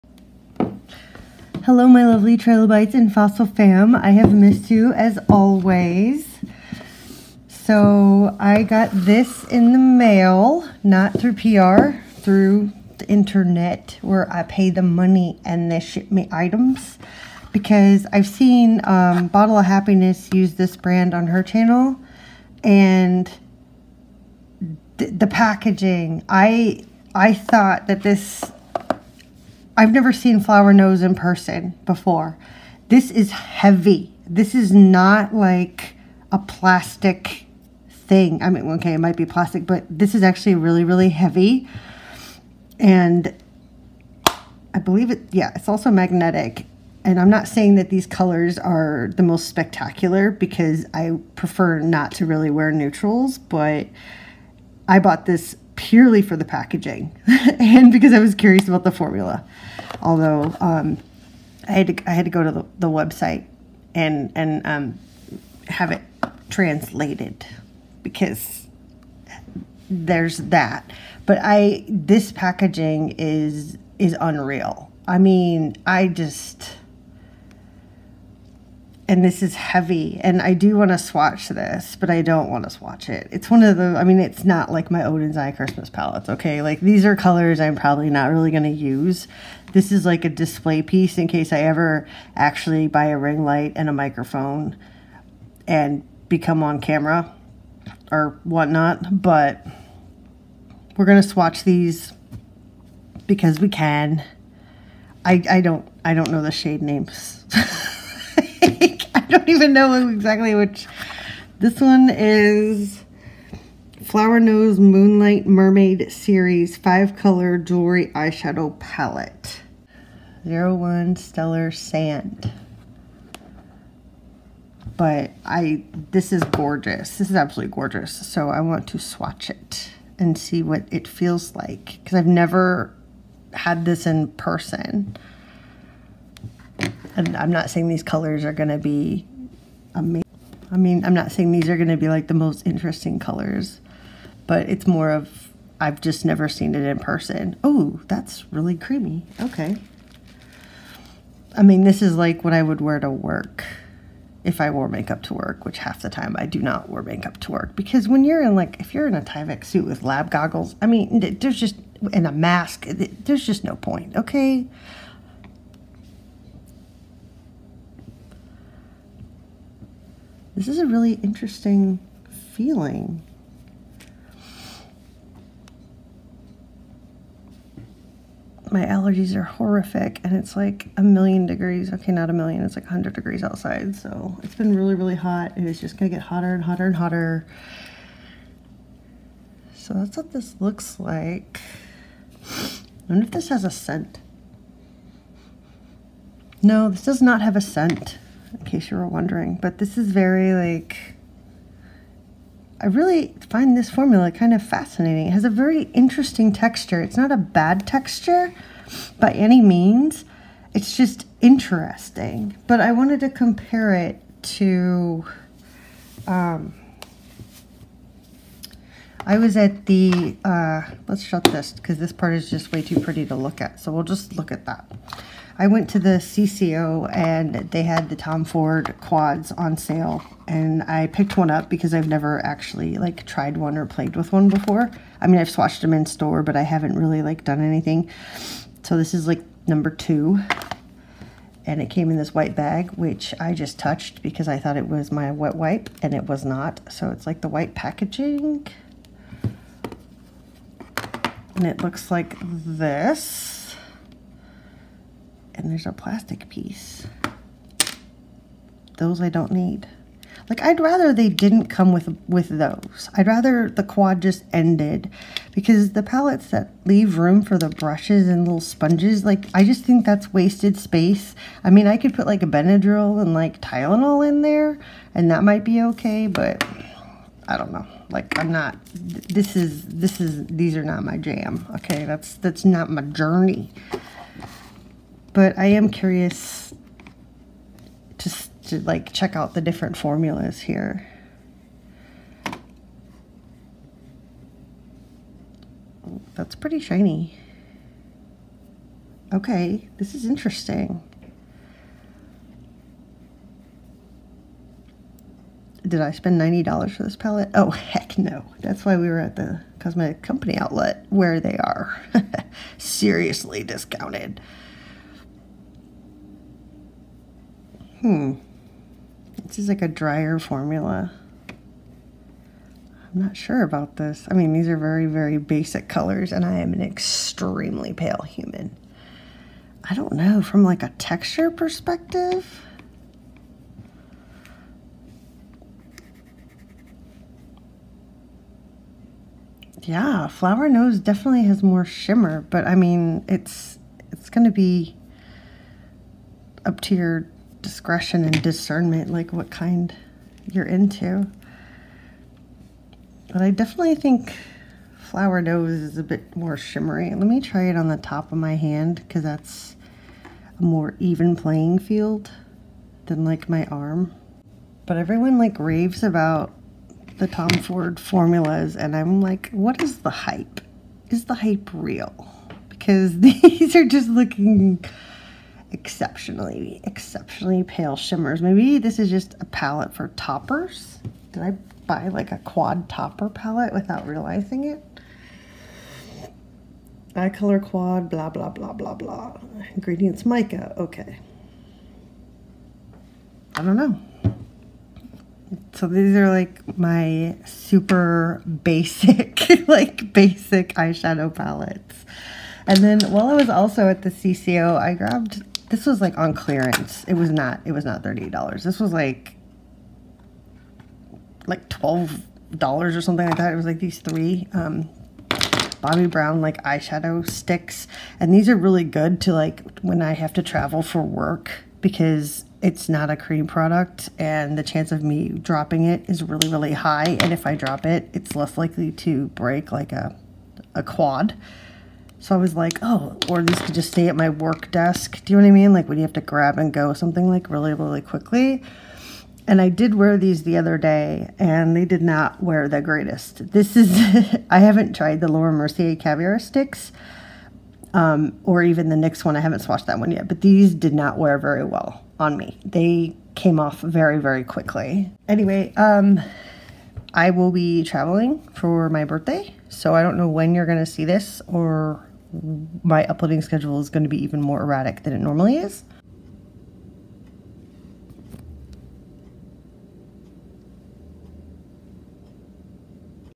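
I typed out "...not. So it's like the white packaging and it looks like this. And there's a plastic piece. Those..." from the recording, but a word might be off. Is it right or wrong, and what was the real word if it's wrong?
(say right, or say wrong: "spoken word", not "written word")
right.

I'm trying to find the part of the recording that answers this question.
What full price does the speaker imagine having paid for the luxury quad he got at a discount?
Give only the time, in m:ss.
5:06.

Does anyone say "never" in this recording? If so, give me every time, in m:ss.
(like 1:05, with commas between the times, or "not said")
0:29, 2:12, 2:26, 3:52.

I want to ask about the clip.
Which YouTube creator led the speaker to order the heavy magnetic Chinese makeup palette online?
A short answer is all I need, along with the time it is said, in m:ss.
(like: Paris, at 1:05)
Bottle of Happiness, at 0:19.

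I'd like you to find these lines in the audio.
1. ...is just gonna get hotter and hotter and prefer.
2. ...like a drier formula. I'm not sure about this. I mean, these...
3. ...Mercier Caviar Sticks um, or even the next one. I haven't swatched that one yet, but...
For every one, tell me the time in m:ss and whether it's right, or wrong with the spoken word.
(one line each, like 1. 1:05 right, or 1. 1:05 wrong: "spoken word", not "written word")
1. 3:05 wrong: "hotter", not "prefer"
2. 5:19 right
3. 7:25 right.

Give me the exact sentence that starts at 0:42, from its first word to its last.
And I believe it, yeah, it's also magnetic.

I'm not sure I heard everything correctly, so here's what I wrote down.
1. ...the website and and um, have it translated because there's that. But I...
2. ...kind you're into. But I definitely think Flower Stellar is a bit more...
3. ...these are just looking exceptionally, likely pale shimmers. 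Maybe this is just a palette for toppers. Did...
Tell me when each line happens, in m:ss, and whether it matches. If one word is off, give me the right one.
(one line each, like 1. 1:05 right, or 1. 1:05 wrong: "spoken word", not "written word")
1. 1:02 right
2. 5:49 wrong: "Knows", not "Stellar"
3. 6:13 wrong: "exceptionally", not "likely".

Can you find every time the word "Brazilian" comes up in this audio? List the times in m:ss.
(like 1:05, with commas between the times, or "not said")
not said.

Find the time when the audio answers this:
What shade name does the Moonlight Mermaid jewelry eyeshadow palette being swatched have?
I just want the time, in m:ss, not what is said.
2:00.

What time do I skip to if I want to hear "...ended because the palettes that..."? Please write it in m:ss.
4:24.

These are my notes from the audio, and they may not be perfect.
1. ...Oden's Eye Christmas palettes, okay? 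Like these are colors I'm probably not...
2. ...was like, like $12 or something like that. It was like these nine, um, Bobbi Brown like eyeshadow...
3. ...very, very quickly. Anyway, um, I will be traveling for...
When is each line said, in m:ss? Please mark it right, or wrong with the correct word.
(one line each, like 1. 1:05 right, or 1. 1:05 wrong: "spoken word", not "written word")
1. 1:25 right
2. 6:48 wrong: "three", not "nine"
3. 7:33 right.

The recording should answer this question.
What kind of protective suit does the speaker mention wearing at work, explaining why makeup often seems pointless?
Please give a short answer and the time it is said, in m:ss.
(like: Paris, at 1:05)
Tyvek suit, at 2:39.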